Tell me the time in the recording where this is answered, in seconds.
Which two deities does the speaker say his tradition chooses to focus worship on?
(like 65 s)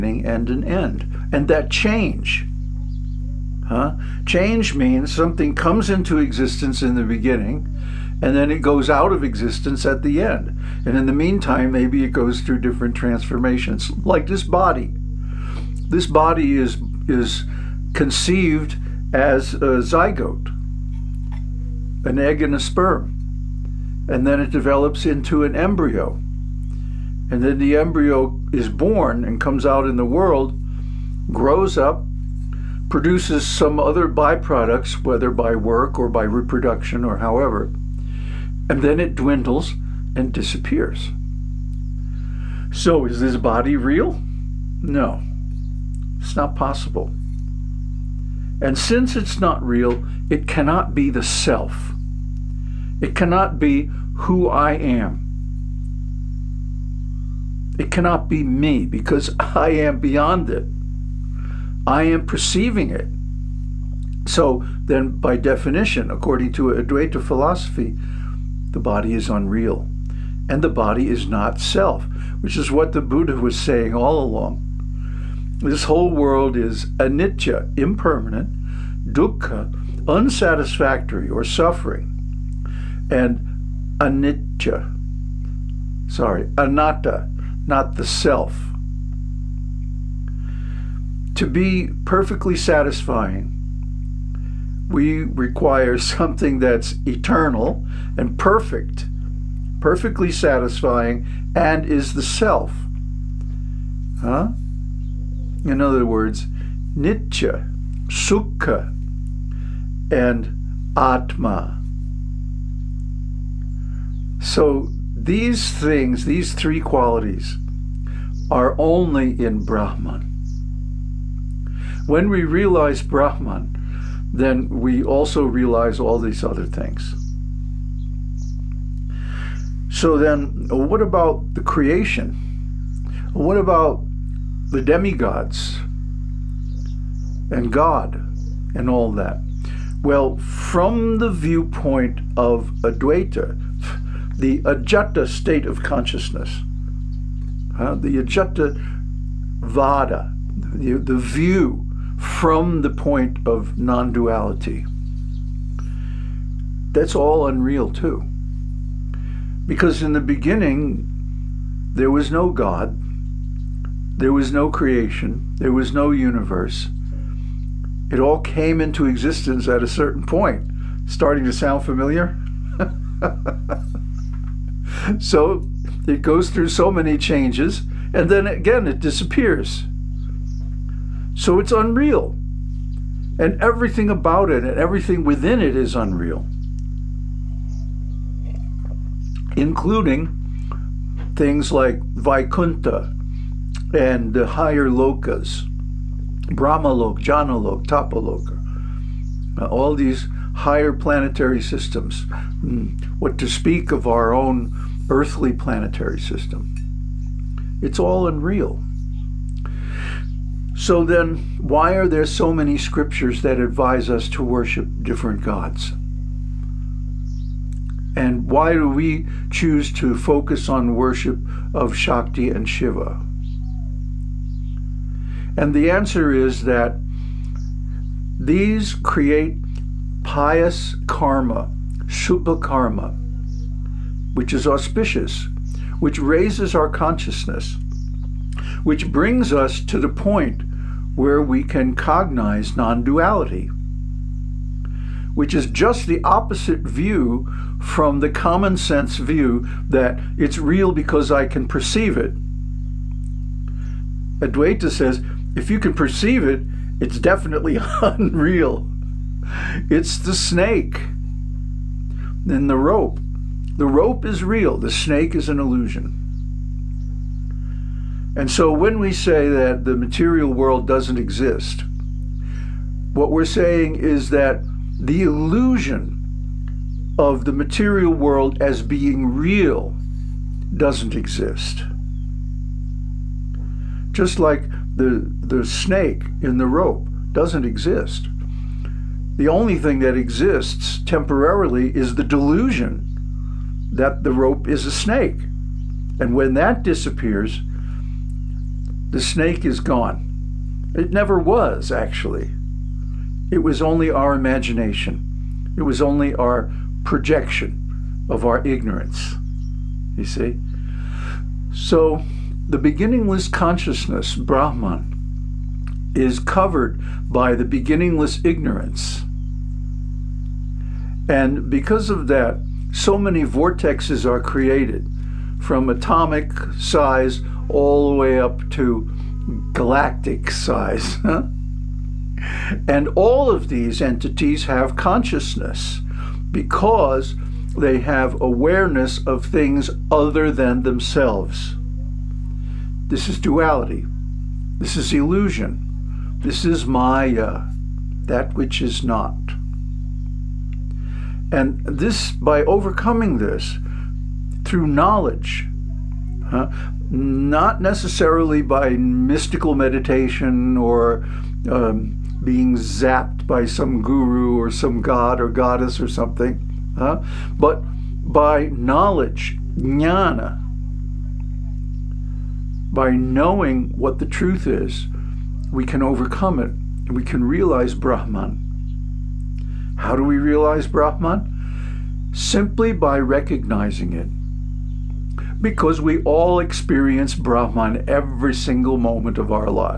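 221 s.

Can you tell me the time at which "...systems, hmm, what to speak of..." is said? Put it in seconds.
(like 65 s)
201 s.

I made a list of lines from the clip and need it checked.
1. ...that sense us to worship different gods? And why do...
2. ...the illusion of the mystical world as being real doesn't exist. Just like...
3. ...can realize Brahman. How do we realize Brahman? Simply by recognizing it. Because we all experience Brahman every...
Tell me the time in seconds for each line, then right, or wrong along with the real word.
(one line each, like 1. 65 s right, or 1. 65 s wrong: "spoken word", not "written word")
1. 213 s wrong: "advise", not "sense"
2. 274 s wrong: "material", not "mystical"
3. 377 s right.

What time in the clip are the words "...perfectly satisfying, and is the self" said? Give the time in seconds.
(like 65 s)
99 s.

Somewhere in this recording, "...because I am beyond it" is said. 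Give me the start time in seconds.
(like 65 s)
58 s.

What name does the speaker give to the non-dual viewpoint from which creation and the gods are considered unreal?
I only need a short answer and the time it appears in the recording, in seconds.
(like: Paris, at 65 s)
Ajata Vada, at 148 s.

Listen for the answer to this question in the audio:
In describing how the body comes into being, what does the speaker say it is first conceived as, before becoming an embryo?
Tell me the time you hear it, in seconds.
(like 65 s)
19 s.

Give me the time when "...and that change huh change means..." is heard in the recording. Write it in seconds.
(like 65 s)
1 s.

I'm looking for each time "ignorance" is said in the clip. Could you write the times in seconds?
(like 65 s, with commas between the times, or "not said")
308 s, 318 s.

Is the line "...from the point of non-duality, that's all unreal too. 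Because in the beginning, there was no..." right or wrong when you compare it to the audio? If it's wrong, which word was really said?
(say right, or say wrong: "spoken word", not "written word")
right.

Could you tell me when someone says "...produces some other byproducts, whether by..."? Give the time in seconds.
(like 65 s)
32 s.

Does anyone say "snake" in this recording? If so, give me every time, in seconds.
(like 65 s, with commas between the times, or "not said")
260 s, 264 s, 285 s, 294 s, 299 s.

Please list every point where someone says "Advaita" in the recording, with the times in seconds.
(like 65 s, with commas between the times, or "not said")
66 s, 142 s, 254 s.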